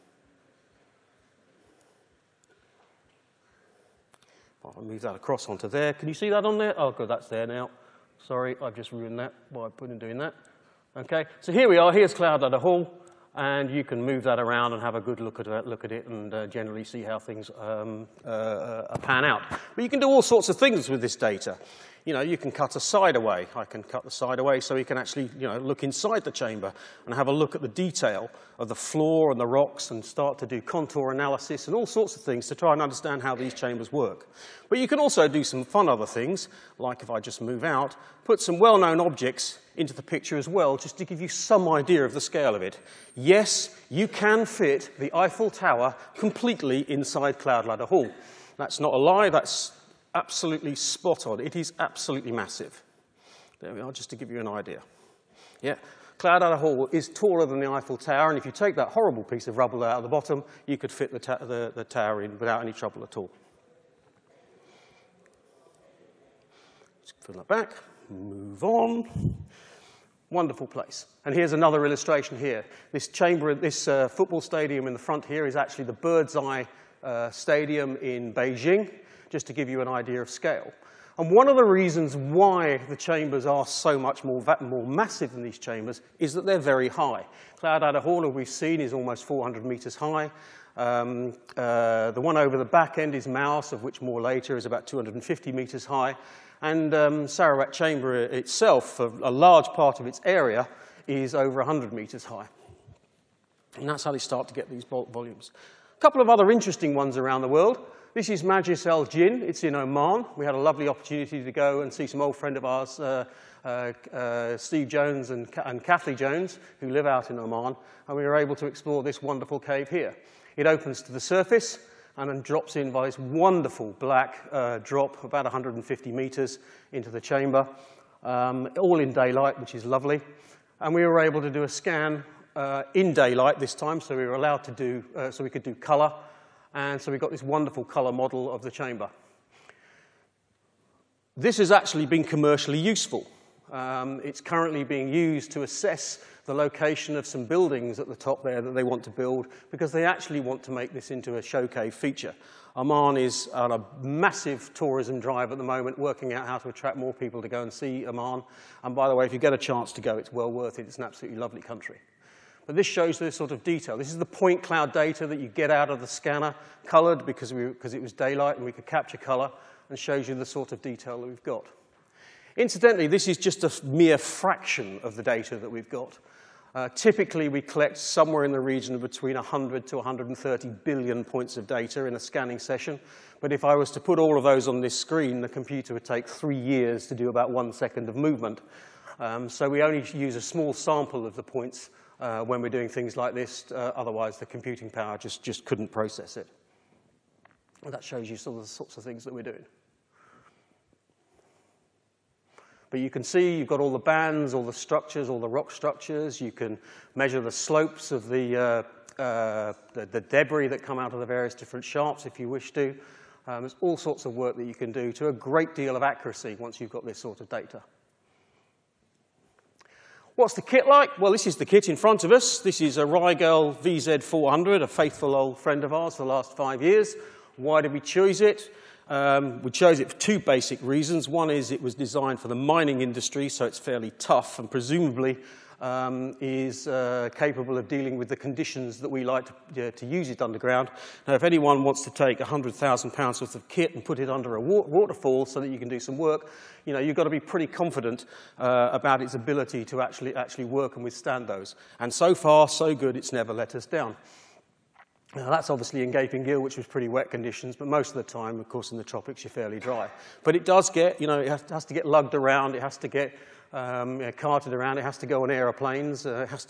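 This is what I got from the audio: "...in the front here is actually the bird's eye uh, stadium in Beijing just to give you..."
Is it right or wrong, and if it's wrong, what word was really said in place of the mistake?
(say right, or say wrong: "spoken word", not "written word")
right.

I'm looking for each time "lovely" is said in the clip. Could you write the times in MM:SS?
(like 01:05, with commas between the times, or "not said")
01:50, 02:09, 02:41.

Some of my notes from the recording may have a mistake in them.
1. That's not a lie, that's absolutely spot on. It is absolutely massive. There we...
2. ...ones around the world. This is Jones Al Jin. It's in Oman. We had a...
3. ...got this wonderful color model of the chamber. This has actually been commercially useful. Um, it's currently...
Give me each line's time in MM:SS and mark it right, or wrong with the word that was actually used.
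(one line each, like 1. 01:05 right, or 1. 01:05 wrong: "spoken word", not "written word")
1. 00:48 right
2. 01:46 wrong: "Majlis", not "Jones"
3. 02:17 right.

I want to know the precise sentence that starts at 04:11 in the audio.
And so far, so good, it's never let us down.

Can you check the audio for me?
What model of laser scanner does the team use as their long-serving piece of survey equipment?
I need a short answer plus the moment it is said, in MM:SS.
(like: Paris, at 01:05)
Riegl VZ400, at 03:43.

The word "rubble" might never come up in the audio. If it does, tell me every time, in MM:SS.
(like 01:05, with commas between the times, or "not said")
00:59.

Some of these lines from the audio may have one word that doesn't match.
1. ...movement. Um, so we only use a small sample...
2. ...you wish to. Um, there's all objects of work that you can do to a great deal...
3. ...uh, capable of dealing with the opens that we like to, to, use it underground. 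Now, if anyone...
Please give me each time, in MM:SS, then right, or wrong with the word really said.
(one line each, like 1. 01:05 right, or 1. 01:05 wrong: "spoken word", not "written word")
1. 03:08 right
2. 03:32 wrong: "sorts", not "objects"
3. 03:56 wrong: "conditions", not "opens".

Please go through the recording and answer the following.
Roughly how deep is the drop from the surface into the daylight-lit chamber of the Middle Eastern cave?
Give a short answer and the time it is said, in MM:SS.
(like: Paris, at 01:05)
150 meters, at 02:05.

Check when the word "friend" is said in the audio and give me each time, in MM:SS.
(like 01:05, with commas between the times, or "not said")
01:52, 03:45.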